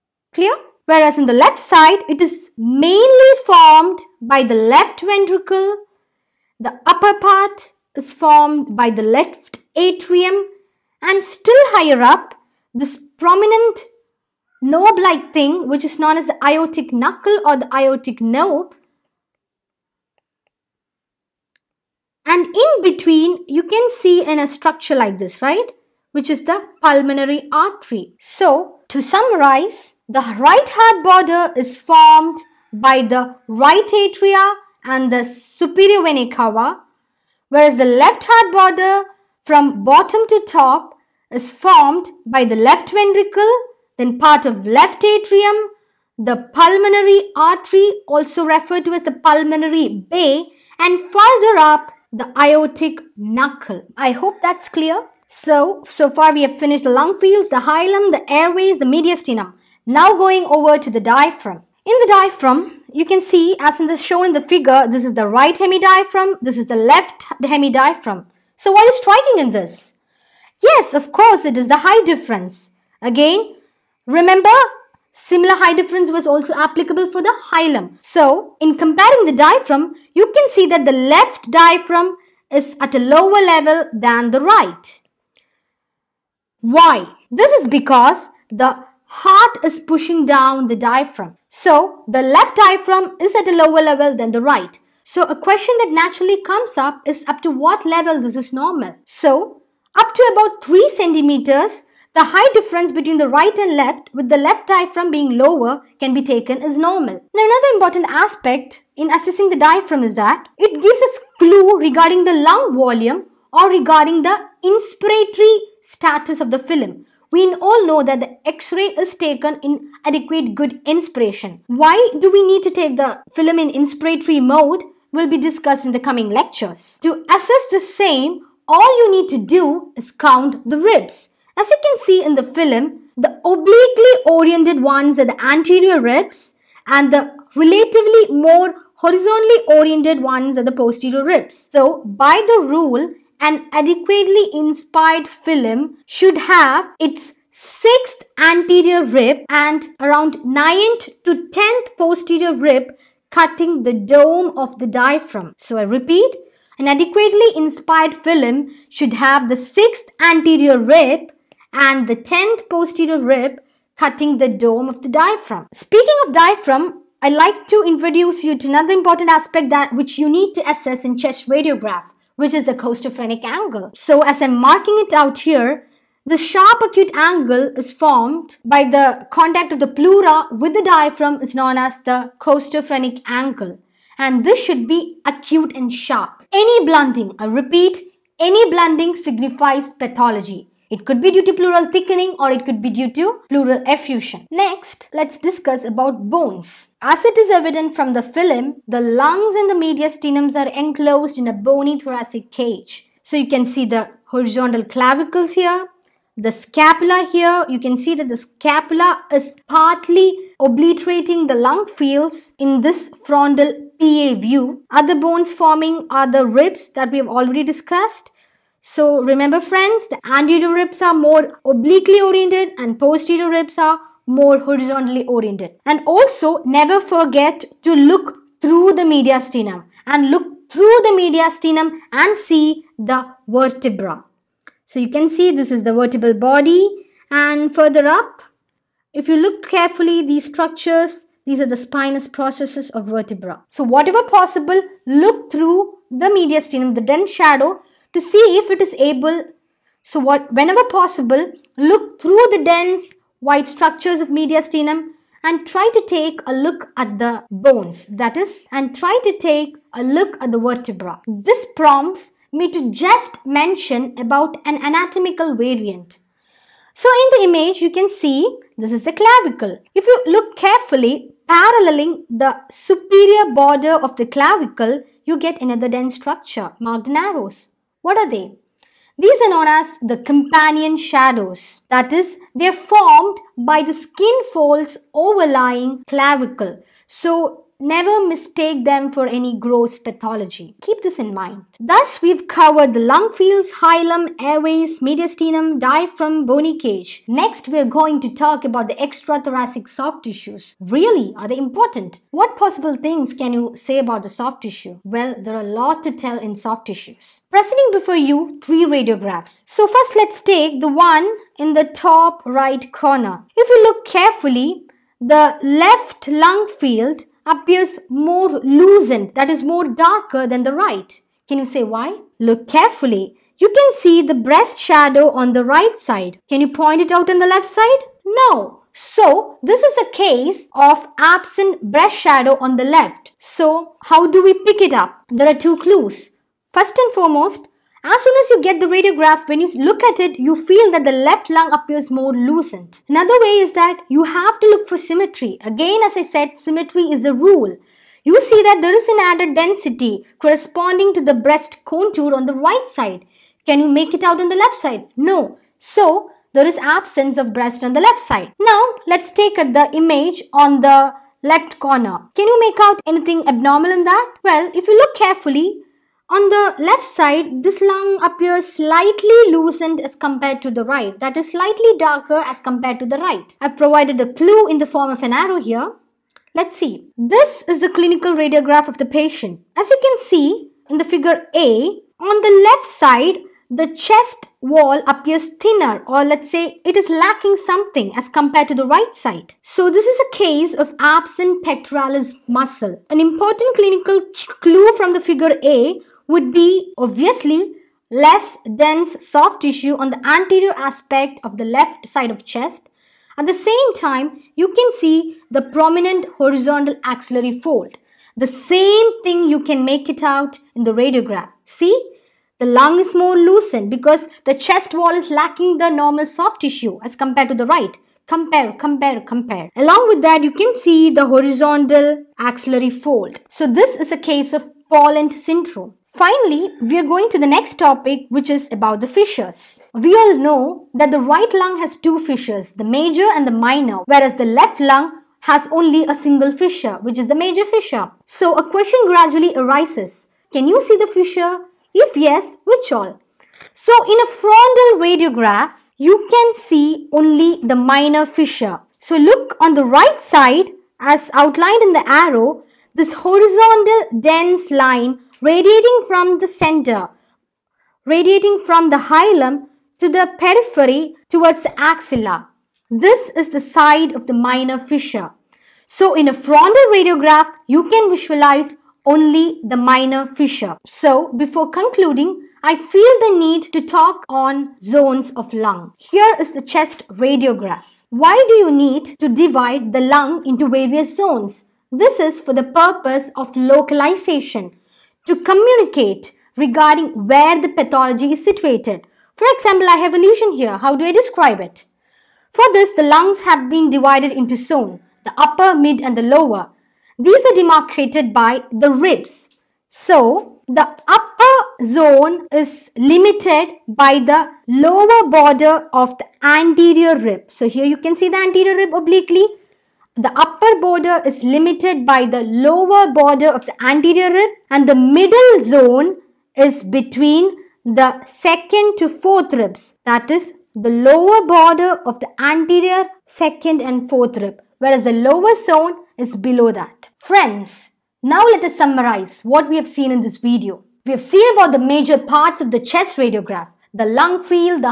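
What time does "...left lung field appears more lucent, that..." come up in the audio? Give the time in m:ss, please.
5:15.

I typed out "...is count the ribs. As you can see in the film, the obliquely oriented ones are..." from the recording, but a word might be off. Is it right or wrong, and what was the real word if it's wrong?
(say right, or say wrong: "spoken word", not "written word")
right.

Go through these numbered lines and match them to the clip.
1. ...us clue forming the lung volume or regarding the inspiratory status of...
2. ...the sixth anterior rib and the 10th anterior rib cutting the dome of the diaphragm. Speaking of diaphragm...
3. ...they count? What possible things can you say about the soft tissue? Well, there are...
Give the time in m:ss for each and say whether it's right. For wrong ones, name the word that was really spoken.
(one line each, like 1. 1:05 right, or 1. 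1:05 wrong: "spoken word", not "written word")
1. 1:51 wrong: "regarding", not "forming"
2. 2:39 wrong: "posterior", not "anterior"
3. 5:01 wrong: "important", not "count".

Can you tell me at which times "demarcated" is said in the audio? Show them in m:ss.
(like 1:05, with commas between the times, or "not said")
8:17.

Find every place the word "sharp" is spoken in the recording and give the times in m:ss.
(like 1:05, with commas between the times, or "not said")
2:56, 3:05.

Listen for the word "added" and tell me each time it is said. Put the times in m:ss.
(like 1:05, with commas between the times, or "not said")
5:49.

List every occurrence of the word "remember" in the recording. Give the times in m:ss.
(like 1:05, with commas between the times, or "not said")
1:14, 3:39.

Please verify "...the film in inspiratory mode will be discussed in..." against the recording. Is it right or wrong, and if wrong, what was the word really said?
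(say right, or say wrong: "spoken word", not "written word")
right.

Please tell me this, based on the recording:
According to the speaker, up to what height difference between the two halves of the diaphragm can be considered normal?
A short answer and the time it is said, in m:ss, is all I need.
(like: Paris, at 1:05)
3 centimeters, at 1:40.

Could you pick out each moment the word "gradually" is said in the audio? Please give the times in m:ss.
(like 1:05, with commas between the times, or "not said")
7:19.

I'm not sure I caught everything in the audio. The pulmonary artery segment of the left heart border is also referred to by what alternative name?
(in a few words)
pulmonary bay.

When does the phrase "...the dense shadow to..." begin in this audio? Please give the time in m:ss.
4:06.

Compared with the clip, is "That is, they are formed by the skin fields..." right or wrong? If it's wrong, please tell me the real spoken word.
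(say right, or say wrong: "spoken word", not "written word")
wrong: "folds", not "fields".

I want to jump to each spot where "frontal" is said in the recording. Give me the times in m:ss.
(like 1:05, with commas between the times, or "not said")
3:33, 7:24, 7:46.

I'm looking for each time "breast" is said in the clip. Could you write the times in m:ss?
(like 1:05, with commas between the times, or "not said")
5:24, 5:31, 5:51, 5:57.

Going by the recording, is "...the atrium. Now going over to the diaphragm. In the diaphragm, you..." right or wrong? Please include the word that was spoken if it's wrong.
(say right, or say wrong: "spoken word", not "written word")
wrong: "mediastinum", not "atrium".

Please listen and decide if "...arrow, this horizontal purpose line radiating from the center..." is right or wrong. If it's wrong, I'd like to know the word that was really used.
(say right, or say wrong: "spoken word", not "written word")
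wrong: "dense", not "purpose".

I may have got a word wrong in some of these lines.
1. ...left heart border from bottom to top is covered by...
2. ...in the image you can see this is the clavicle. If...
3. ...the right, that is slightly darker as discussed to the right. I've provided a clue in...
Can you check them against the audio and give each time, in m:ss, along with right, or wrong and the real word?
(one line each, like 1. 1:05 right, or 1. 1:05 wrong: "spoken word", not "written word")
1. 0:37 wrong: "formed", not "covered"
2. 4:27 right
3. 6:10 wrong: "compared", not "discussed".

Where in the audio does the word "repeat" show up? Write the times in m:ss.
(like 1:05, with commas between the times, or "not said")
2:35, 3:07.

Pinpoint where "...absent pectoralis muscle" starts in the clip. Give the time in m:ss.
6:30.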